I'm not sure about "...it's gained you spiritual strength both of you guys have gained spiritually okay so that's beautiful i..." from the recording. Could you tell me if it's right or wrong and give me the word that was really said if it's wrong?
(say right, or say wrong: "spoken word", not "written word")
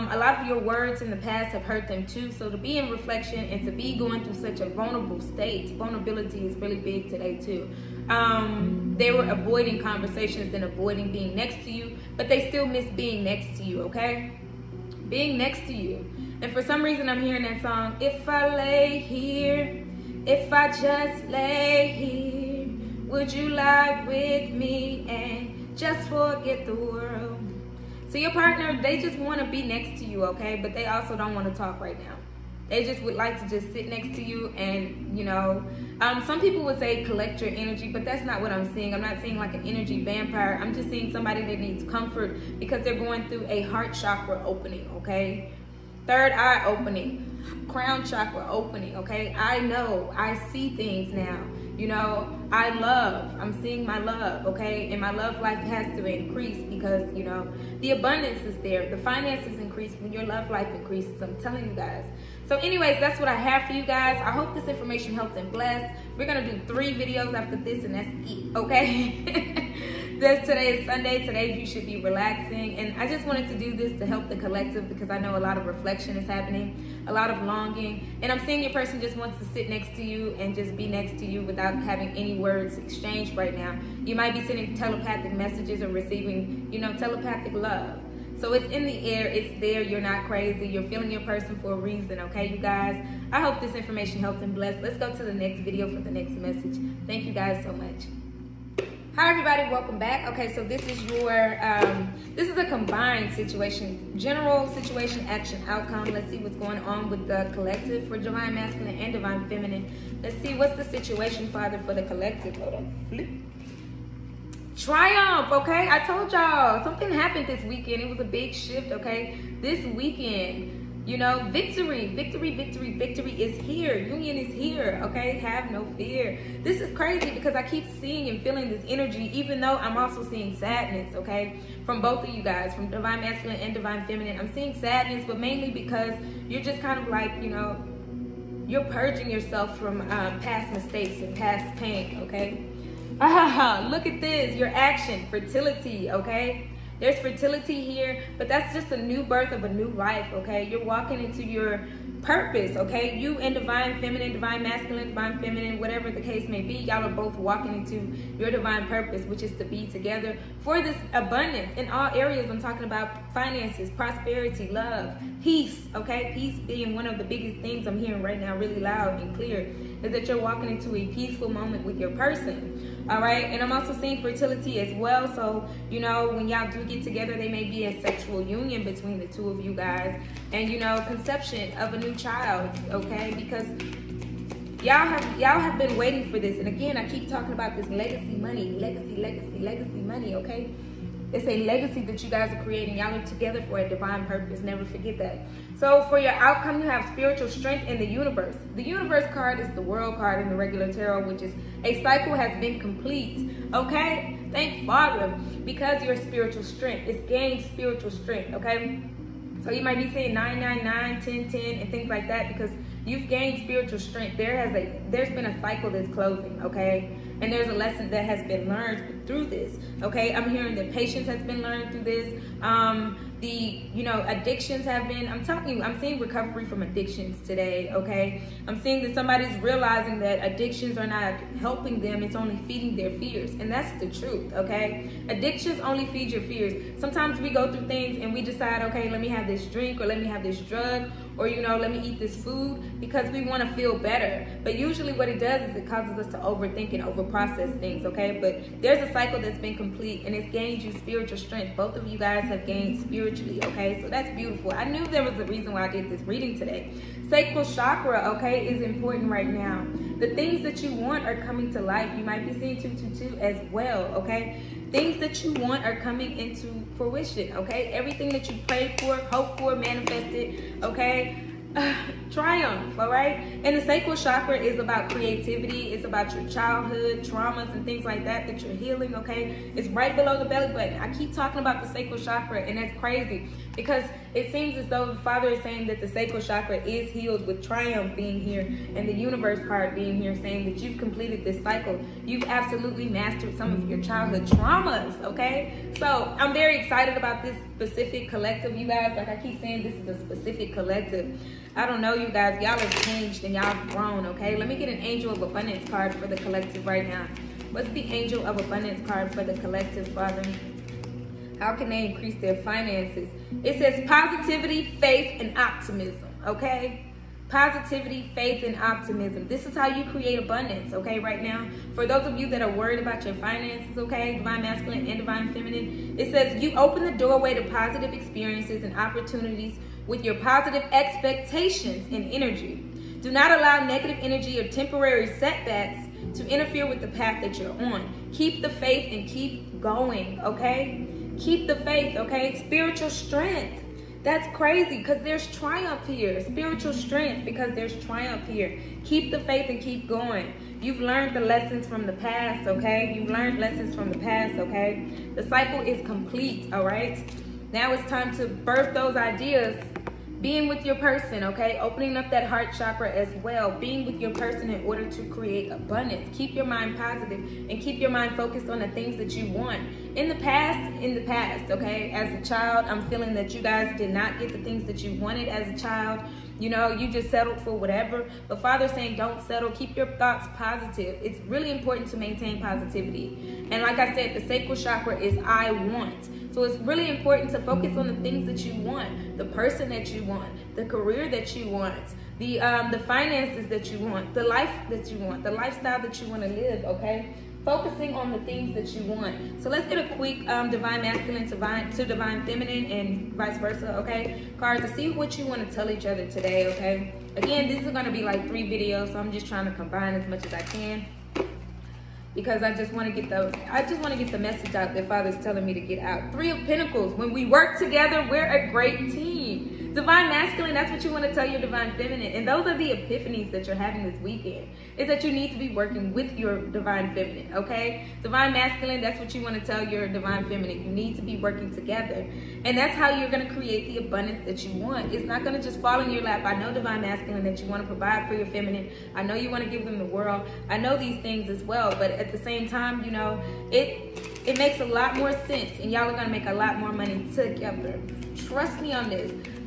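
right.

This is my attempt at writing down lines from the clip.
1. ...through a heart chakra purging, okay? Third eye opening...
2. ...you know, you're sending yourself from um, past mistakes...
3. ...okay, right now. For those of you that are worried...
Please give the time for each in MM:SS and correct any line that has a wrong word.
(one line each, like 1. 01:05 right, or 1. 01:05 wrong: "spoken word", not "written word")
1. 00:43 wrong: "opening", not "purging"
2. 02:17 wrong: "purging", not "sending"
3. 05:20 right.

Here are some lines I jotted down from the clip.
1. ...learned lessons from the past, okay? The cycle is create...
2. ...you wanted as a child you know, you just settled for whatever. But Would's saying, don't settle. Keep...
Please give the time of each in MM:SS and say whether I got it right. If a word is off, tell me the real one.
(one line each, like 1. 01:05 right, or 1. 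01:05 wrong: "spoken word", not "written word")
1. 05:53 wrong: "complete", not "create"
2. 06:15 wrong: "Father", not "Would".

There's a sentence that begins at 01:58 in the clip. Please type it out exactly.
It was a big shift, okay?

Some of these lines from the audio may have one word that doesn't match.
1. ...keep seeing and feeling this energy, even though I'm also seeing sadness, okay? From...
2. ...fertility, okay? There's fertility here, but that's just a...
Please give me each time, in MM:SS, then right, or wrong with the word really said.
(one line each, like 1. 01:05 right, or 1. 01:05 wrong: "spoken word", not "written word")
1. 02:07 right
2. 02:25 right.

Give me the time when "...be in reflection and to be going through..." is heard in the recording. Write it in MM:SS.
00:02.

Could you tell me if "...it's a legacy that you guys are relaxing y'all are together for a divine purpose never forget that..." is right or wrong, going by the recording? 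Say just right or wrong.
wrong.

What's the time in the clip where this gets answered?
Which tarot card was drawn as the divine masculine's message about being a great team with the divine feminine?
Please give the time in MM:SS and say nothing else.
06:56.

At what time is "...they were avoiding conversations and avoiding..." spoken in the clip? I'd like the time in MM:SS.
00:08.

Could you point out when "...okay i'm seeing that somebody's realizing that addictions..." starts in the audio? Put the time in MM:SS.
03:47.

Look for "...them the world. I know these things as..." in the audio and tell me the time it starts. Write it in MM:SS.
07:19.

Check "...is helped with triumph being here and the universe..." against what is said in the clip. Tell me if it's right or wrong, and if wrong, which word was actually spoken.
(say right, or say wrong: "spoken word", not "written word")
wrong: "healed", not "helped".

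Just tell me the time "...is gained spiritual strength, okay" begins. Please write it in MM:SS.
03:27.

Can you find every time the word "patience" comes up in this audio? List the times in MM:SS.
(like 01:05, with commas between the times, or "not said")
03:40.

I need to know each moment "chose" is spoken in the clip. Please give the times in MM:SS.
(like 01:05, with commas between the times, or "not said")
not said.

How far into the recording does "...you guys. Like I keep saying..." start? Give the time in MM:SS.
04:58.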